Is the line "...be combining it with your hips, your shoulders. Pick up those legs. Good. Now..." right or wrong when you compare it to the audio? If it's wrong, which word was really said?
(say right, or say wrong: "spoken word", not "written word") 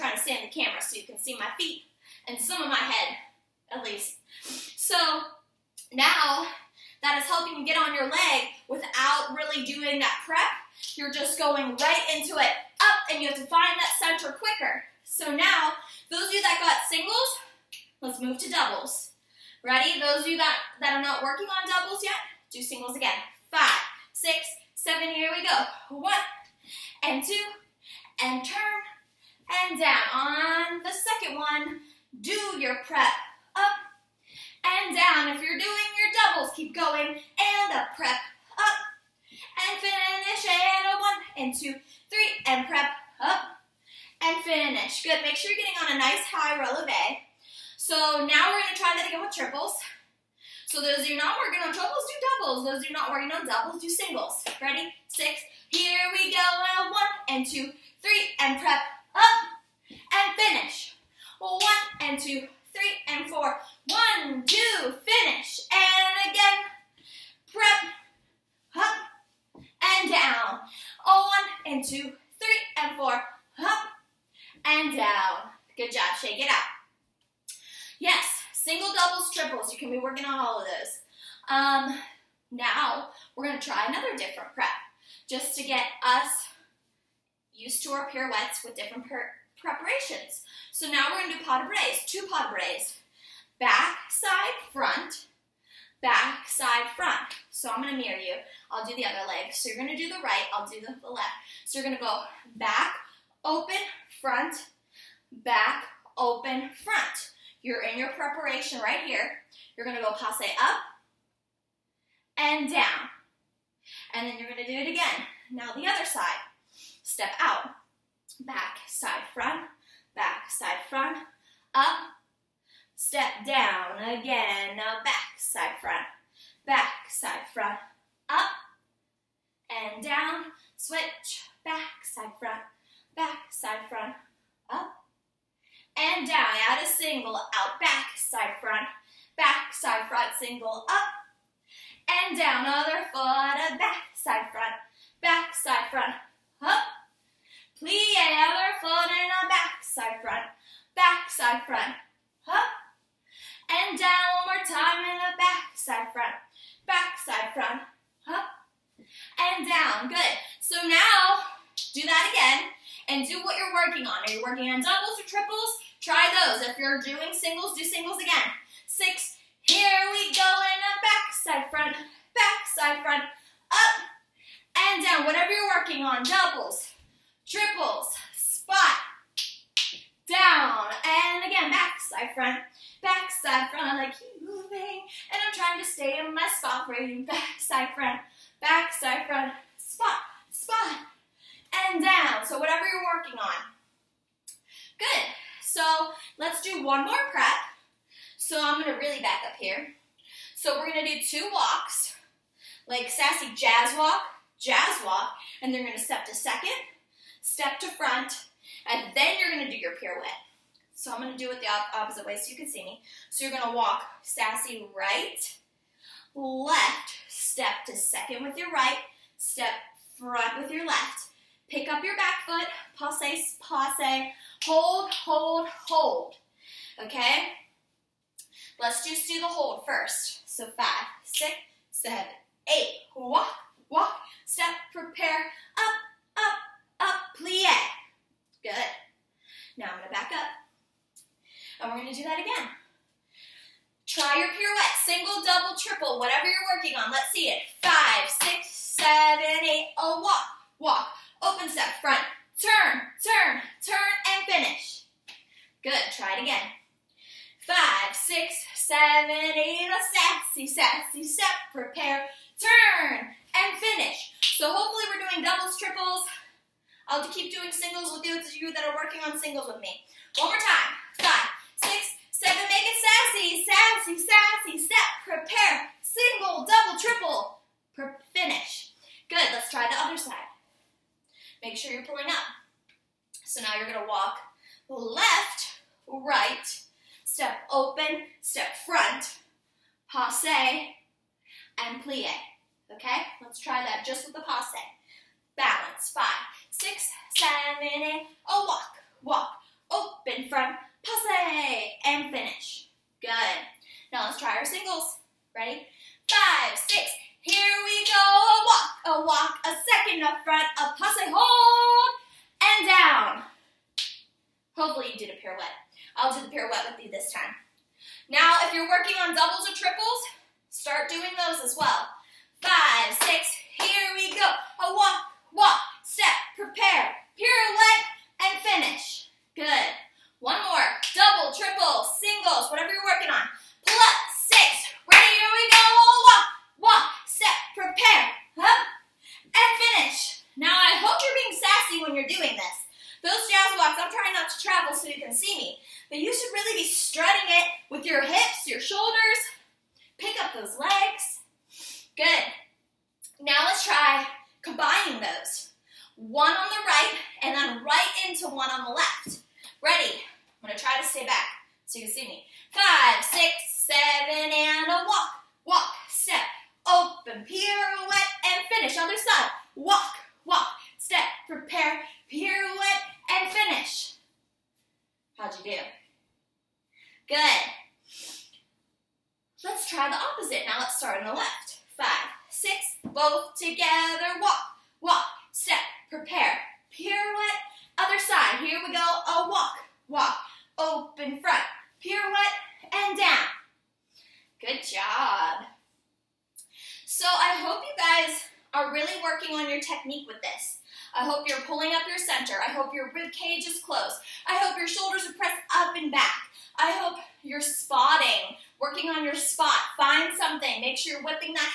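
wrong: "strutting", not "combining".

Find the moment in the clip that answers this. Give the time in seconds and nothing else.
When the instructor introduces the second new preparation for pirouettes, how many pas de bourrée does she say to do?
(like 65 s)
92 s.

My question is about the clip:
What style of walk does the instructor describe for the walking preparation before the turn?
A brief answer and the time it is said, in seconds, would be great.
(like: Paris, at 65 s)
sassy jazz walk, at 203 s.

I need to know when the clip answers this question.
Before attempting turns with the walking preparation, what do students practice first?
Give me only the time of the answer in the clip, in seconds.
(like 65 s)
229 s.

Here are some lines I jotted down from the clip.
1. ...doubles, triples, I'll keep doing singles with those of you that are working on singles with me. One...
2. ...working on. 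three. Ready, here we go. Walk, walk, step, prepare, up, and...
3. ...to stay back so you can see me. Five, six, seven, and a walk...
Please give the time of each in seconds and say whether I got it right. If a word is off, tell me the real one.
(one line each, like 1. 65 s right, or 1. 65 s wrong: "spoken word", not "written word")
1. 265 s right
2. 333 s wrong: "six", not "three"
3. 361 s right.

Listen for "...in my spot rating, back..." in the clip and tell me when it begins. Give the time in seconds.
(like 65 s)
186 s.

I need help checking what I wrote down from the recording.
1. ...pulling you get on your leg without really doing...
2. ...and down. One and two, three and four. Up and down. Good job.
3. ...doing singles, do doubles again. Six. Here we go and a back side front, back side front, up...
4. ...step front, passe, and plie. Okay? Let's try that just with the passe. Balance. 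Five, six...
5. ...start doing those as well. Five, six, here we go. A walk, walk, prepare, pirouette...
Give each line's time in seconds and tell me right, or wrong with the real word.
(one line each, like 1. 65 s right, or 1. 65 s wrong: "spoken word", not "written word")
1. 7 s wrong: "helping", not "pulling"
2. 69 s right
3. 167 s wrong: "singles", not "doubles"
4. 288 s right
5. 320 s right.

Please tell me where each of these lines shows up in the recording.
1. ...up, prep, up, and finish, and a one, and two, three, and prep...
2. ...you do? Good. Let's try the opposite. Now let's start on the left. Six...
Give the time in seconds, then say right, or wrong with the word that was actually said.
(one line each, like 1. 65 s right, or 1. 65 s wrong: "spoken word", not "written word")
1. 37 s right
2. 375 s wrong: "Five", not "Six".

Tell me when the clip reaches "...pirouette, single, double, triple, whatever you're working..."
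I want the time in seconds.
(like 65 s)
244 s.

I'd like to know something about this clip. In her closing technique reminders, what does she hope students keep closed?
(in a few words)
rib cage.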